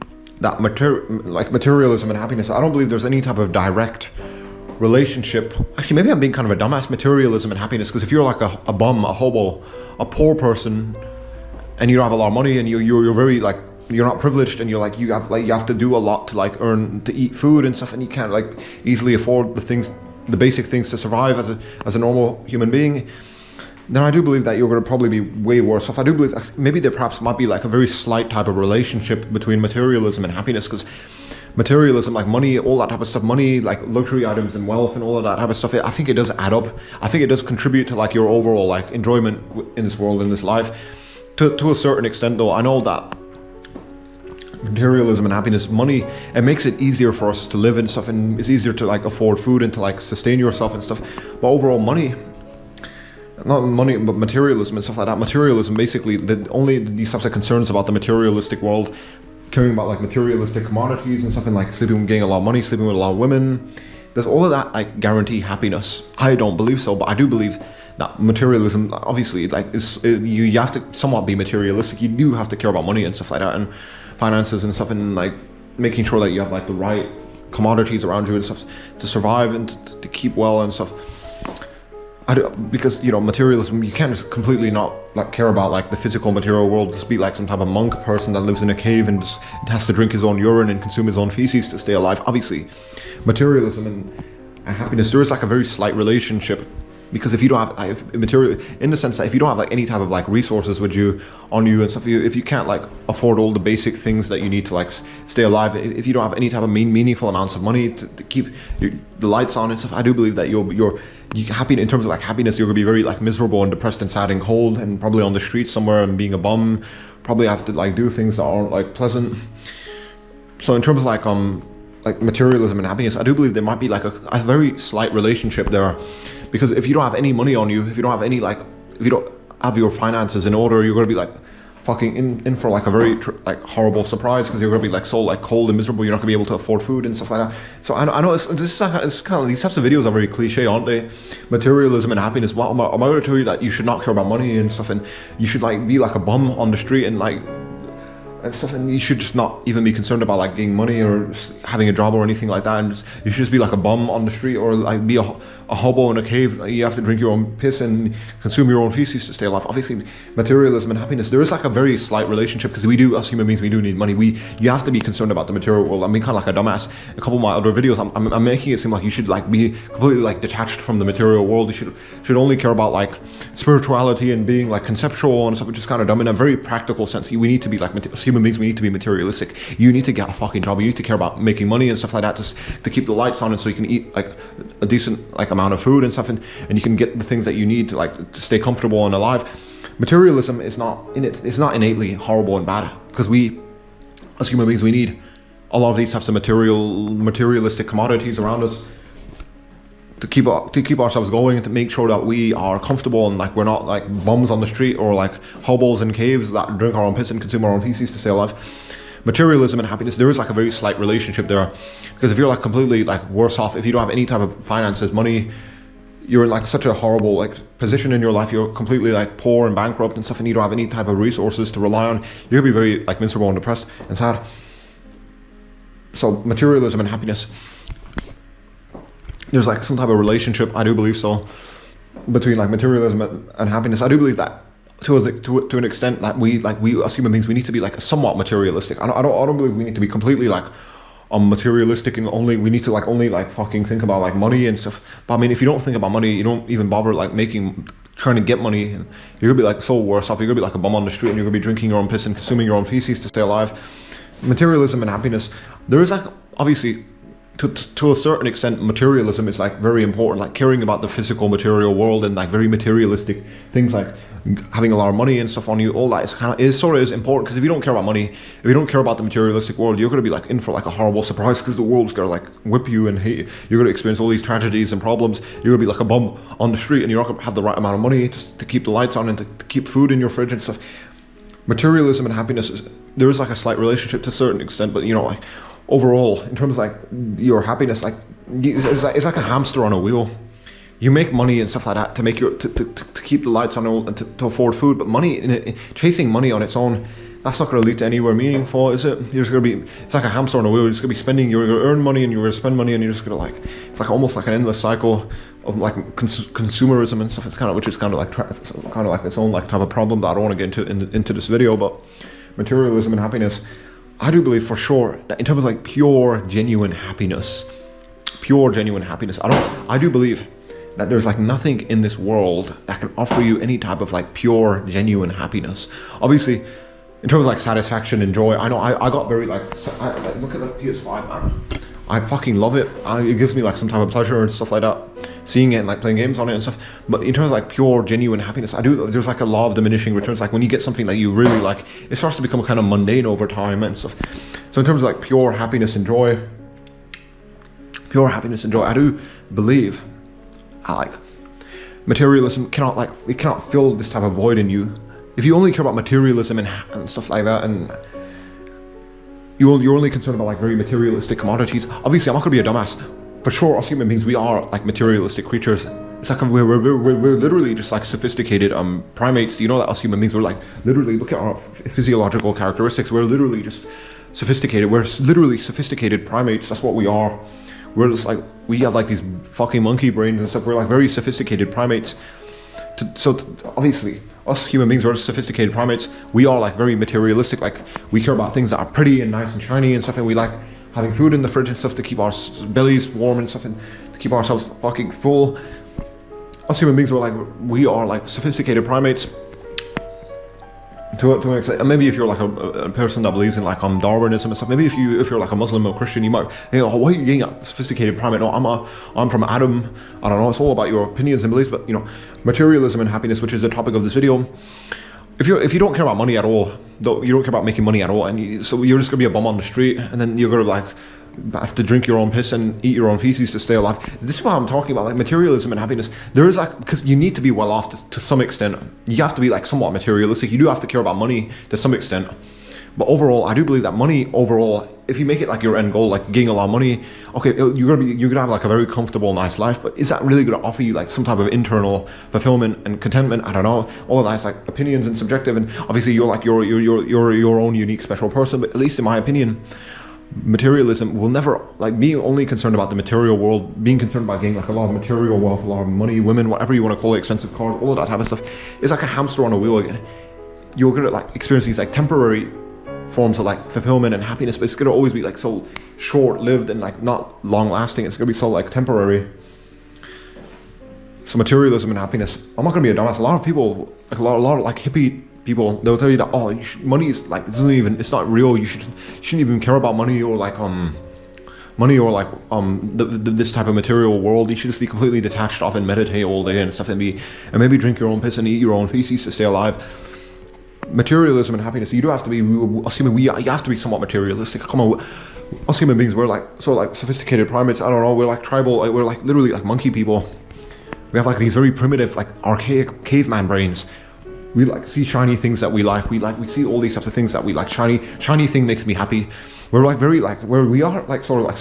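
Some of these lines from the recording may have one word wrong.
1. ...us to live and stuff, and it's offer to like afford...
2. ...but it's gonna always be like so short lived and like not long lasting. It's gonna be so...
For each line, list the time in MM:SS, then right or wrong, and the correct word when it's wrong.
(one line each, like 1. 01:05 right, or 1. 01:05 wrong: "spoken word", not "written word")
1. 00:47 wrong: "easier", not "offer"
2. 07:44 right.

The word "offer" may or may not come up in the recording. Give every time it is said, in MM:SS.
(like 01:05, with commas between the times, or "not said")
05:23, 07:20.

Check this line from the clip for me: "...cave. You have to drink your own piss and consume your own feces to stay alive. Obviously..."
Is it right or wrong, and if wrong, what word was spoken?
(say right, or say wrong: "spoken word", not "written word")
right.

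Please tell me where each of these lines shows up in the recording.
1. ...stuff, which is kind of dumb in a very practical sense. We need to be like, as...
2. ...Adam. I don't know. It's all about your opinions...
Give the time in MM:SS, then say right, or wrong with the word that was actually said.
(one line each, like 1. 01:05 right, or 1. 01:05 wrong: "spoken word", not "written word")
1. 02:55 right
2. 06:49 right.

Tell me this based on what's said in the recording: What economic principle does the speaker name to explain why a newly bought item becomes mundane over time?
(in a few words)
law of diminishing returns.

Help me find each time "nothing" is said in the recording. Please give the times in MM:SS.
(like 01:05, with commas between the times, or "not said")
05:21.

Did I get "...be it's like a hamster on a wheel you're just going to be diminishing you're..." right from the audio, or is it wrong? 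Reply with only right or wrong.
wrong.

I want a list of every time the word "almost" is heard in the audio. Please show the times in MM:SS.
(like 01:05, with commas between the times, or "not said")
05:04.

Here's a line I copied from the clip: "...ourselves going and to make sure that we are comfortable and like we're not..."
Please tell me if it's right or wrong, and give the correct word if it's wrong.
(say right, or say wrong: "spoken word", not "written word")
right.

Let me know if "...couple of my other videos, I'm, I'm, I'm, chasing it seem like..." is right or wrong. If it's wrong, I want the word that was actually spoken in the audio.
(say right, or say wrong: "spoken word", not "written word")
wrong: "making", not "chasing".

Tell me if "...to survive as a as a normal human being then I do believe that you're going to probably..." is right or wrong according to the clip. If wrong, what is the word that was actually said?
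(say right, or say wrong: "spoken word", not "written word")
right.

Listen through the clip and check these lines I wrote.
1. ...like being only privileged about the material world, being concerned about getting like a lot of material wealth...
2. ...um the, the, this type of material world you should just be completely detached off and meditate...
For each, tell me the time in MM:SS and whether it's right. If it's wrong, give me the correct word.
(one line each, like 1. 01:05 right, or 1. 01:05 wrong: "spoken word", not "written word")
1. 07:31 wrong: "concerned", not "privileged"
2. 08:02 right.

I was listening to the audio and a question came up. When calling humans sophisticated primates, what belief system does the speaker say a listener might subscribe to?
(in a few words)
Darwinism.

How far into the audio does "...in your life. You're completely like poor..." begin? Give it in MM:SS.
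03:38.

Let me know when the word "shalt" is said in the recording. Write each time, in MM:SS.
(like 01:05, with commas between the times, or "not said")
not said.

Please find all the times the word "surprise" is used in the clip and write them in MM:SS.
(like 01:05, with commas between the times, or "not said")
02:14, 04:31.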